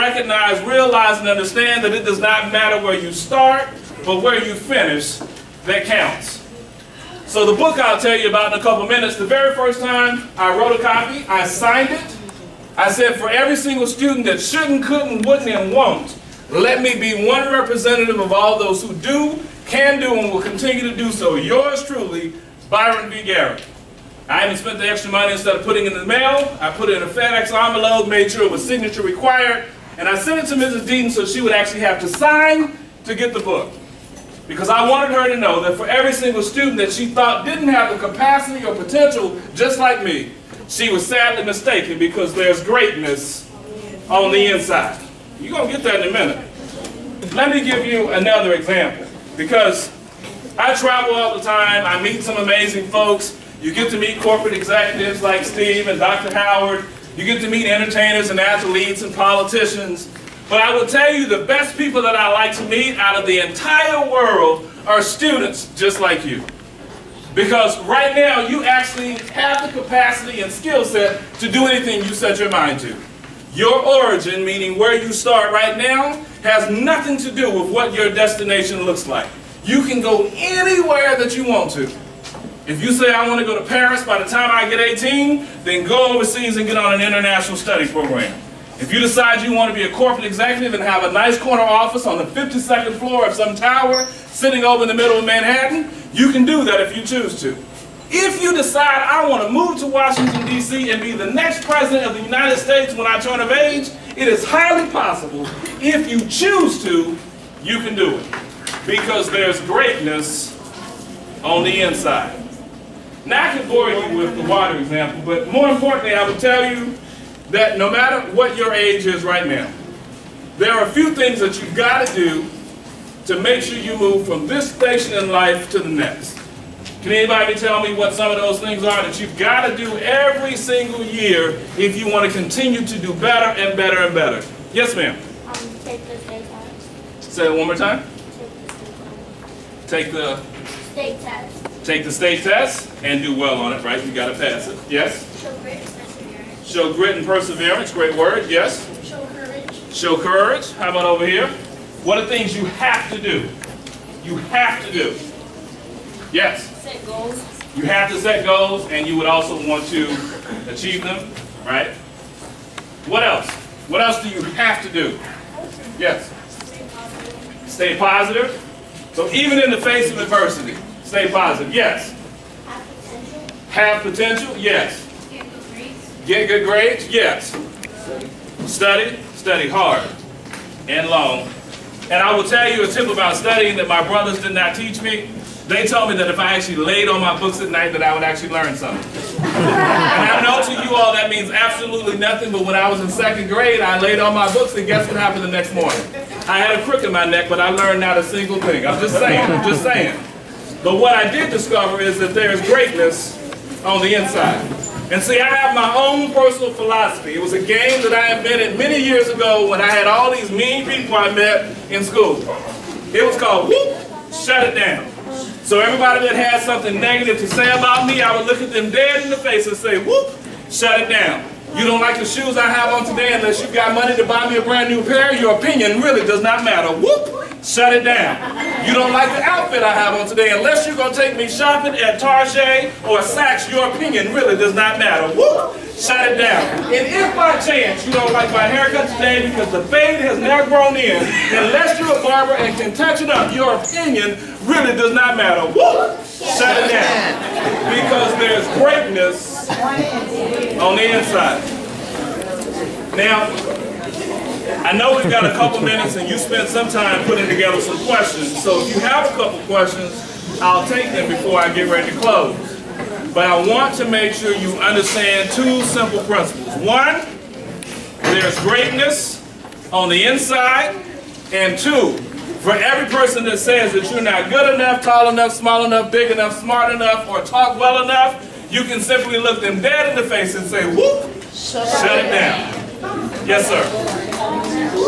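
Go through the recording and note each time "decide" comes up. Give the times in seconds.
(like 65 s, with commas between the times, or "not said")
88 s, 98 s.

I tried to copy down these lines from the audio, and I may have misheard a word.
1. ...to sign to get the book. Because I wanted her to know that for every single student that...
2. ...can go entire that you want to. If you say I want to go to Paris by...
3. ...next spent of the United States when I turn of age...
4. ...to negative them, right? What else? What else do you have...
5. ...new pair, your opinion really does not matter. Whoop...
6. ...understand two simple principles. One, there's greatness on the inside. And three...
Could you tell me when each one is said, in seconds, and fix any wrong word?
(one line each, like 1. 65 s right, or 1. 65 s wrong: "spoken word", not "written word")
1. 32 s right
2. 79 s wrong: "anywhere", not "entire"
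3. 101 s wrong: "president", not "spent"
4. 159 s wrong: "achieve", not "negative"
5. 224 s right
6. 264 s wrong: "two", not "three".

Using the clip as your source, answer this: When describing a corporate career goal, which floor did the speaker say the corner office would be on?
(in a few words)
52nd floor.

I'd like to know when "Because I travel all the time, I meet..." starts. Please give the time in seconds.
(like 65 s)
49 s.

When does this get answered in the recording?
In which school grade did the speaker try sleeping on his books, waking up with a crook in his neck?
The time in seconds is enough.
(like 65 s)
193 s.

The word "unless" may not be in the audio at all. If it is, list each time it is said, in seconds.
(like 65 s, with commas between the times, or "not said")
223 s, 230 s, 241 s.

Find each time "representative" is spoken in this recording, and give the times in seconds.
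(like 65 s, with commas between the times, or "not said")
17 s.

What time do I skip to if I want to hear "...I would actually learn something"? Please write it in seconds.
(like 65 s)
188 s.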